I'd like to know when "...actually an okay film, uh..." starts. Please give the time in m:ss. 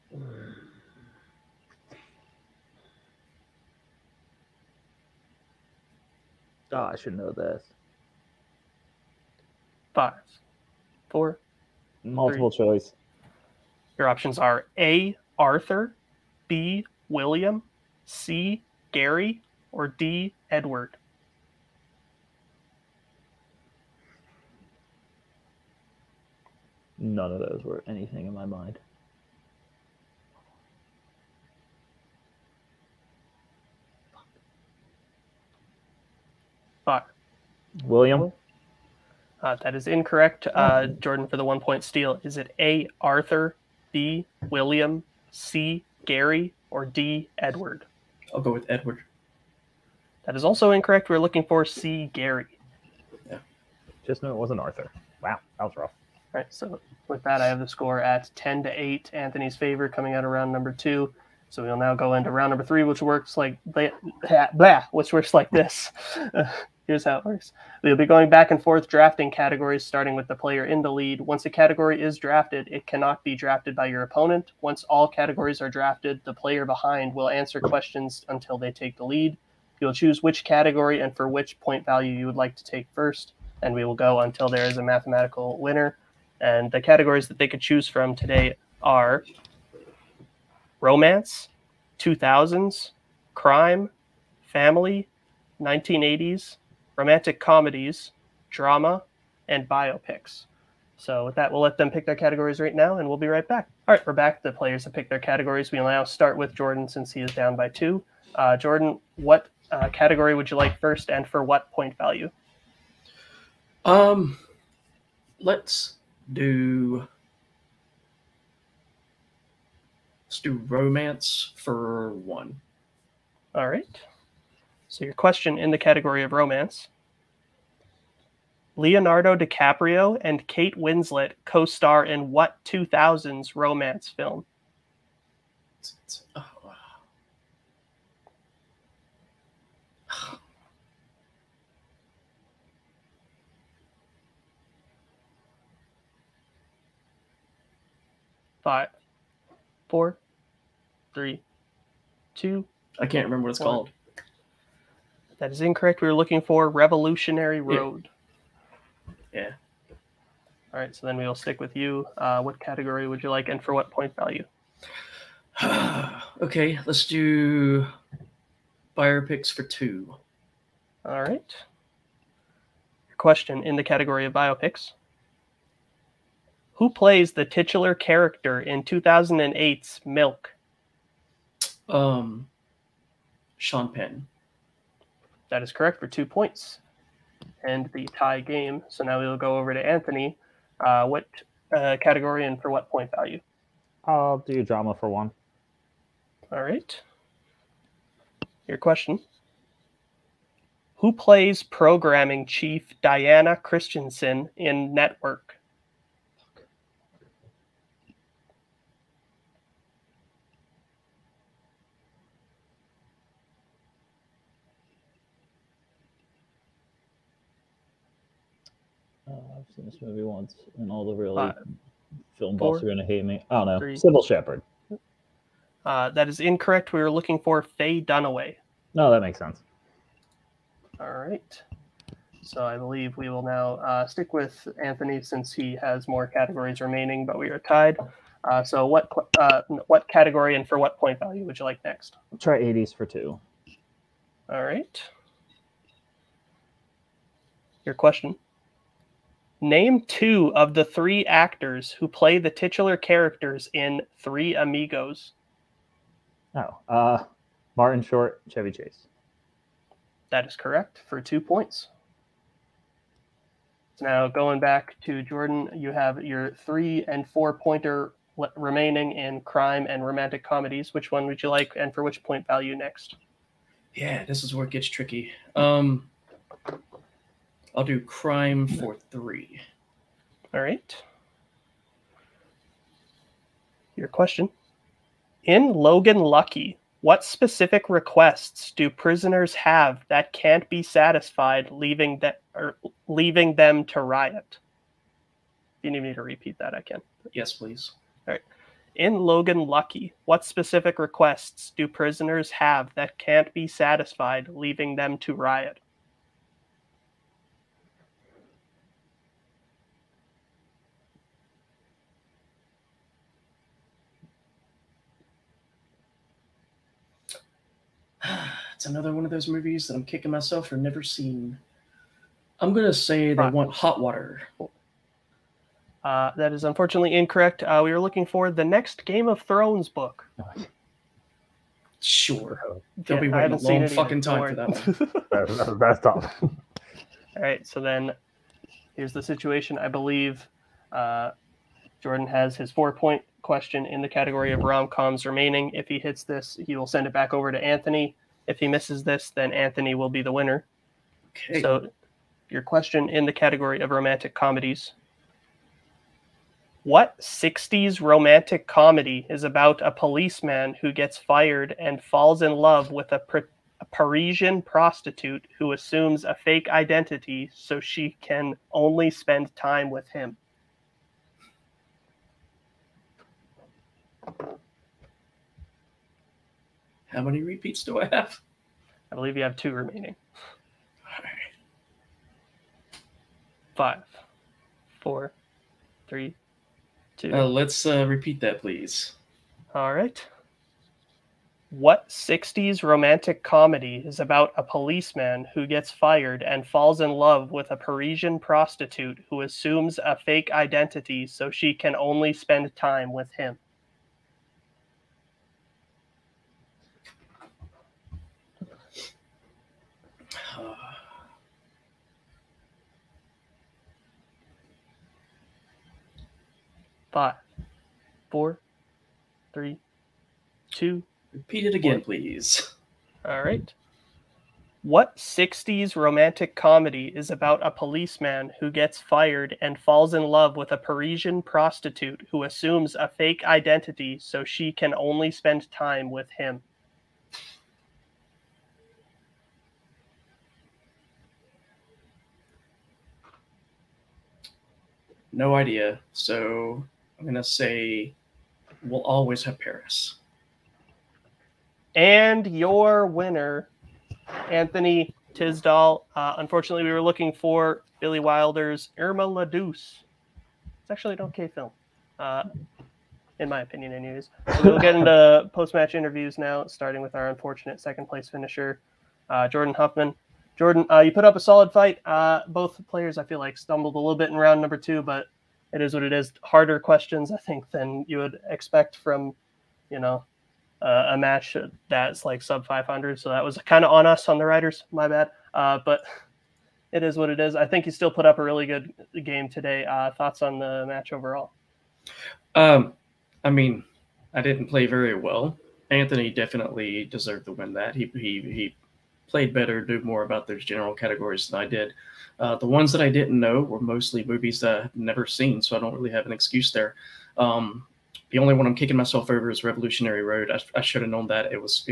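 7:40.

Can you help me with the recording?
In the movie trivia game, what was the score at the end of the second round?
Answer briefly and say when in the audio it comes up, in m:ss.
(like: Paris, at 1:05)
10 to 8, at 0:58.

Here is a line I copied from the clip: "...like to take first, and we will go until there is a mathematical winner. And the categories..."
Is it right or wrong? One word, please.
right.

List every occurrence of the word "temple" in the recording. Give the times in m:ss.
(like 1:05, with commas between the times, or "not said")
not said.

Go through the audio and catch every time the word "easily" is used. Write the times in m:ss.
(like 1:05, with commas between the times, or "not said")
not said.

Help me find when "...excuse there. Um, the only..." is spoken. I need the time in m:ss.
8:26.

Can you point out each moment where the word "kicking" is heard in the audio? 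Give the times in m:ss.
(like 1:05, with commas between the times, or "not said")
5:20, 8:28.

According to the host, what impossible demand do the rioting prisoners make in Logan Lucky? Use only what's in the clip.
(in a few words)
The next Game of Thrones book.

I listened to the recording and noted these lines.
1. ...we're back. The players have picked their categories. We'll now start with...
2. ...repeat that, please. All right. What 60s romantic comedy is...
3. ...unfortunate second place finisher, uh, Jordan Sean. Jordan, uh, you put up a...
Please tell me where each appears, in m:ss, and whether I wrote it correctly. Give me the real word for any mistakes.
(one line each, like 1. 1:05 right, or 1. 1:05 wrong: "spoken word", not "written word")
1. 1:44 right
2. 6:28 right
3. 7:47 wrong: "Huffman", not "Sean".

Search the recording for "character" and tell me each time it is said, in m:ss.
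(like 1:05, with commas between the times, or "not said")
2:57, 4:12.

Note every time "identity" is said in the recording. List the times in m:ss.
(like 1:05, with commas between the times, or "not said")
6:06, 6:40, 7:13.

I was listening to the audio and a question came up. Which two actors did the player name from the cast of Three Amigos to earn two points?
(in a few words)
Martin Short, Chevy Chase.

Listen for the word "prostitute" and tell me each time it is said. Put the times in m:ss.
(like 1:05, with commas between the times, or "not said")
6:04, 6:38, 7:11.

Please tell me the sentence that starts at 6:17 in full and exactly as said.
How many repeats do I have?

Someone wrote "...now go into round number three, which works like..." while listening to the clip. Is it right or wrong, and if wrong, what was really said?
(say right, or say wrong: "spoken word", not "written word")
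right.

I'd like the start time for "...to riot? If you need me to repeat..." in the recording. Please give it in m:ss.
4:53.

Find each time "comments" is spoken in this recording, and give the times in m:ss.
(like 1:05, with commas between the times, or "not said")
not said.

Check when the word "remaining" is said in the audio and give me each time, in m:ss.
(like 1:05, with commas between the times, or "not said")
3:56, 4:28, 5:45, 6:19.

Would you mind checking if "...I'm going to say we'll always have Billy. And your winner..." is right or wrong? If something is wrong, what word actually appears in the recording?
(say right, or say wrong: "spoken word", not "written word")
wrong: "Paris", not "Billy".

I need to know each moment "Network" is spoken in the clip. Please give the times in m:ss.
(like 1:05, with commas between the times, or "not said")
3:24.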